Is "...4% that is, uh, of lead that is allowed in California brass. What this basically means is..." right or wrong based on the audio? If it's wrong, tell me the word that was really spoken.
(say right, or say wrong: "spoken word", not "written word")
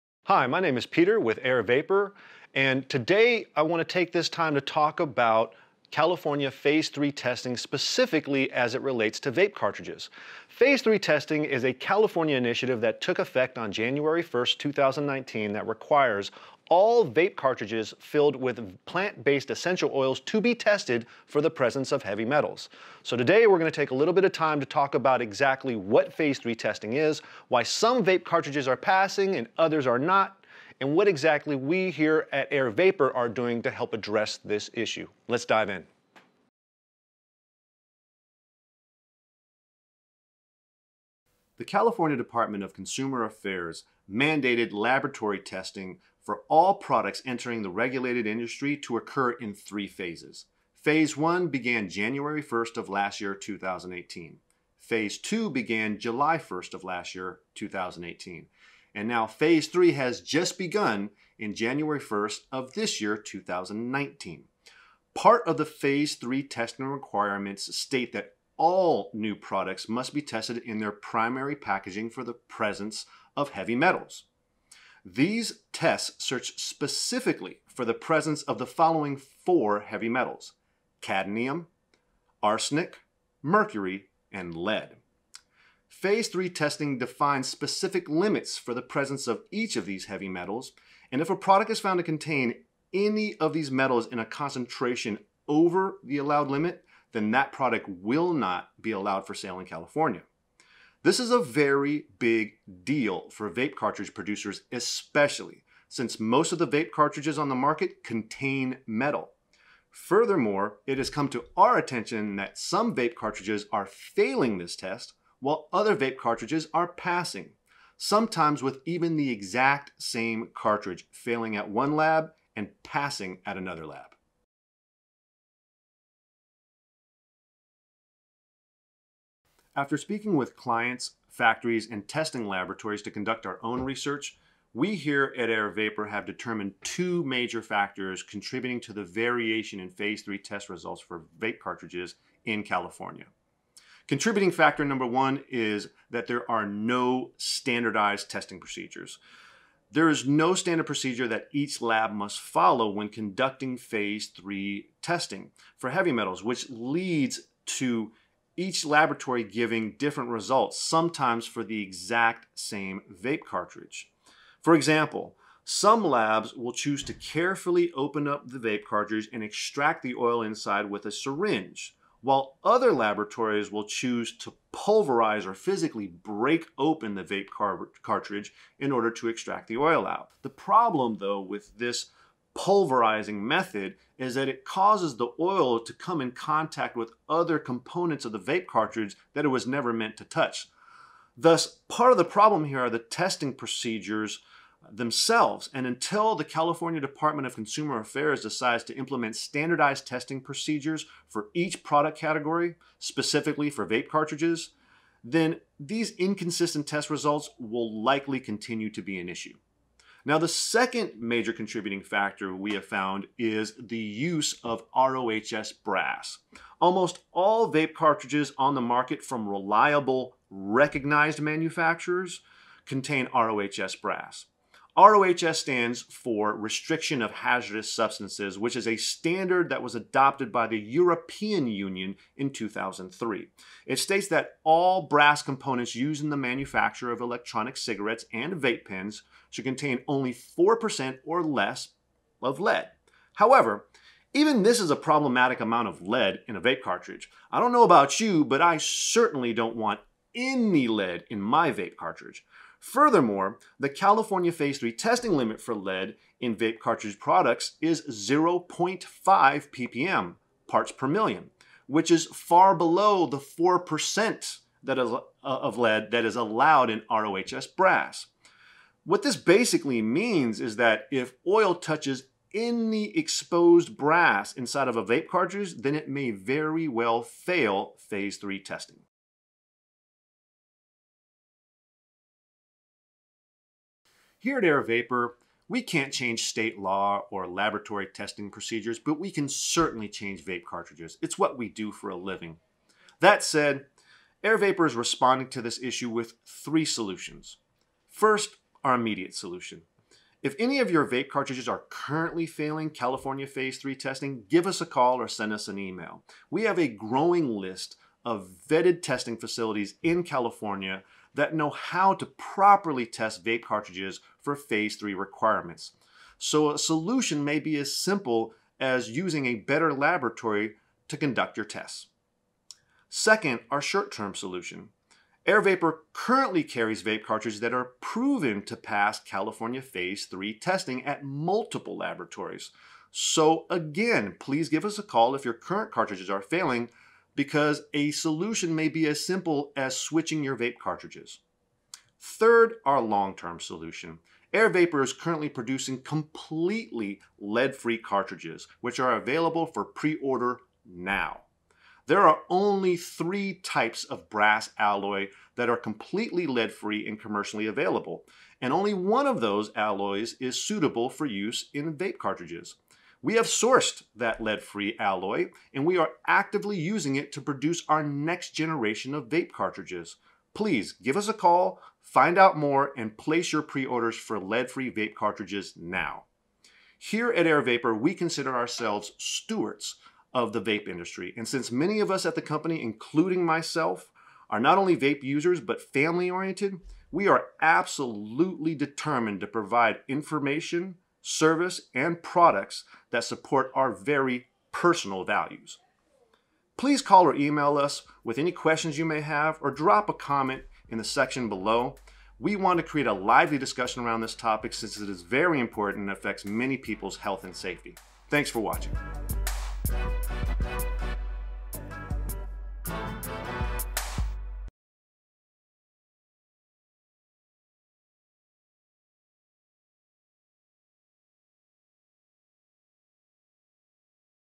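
wrong: "ROHS", not "California".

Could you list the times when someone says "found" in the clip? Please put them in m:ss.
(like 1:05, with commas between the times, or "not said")
1:31, 3:32.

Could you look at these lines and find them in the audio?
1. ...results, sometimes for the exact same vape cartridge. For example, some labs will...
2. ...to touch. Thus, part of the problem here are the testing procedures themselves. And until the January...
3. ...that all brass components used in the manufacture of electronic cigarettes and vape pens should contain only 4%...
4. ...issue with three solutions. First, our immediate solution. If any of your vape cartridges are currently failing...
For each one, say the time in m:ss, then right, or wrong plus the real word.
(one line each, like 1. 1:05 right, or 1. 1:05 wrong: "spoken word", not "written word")
1. 2:40 right
2. 3:10 wrong: "California", not "January"
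3. 3:54 right
4. 4:55 right.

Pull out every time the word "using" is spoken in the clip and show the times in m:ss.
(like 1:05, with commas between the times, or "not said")
5:19, 6:06.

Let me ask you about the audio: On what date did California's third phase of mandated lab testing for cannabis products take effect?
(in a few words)
January 1st, 2019.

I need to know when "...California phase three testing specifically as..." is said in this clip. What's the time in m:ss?
0:05.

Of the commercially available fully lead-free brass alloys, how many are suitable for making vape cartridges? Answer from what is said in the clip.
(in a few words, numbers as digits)
1.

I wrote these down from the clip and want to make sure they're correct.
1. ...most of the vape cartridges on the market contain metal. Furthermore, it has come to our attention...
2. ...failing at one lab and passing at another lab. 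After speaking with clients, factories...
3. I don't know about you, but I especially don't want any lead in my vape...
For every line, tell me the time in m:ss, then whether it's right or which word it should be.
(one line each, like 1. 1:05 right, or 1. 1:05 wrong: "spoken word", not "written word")
1. 1:46 right
2. 2:01 right
3. 4:07 wrong: "certainly", not "especially".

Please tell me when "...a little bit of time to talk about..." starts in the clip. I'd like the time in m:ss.
0:23.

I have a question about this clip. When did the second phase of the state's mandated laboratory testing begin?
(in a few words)
July 1st, 2018.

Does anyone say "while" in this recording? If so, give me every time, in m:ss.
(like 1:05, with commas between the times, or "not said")
1:55, 2:52.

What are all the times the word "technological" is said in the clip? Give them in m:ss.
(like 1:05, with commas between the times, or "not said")
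not said.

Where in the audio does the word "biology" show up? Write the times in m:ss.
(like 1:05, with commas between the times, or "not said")
not said.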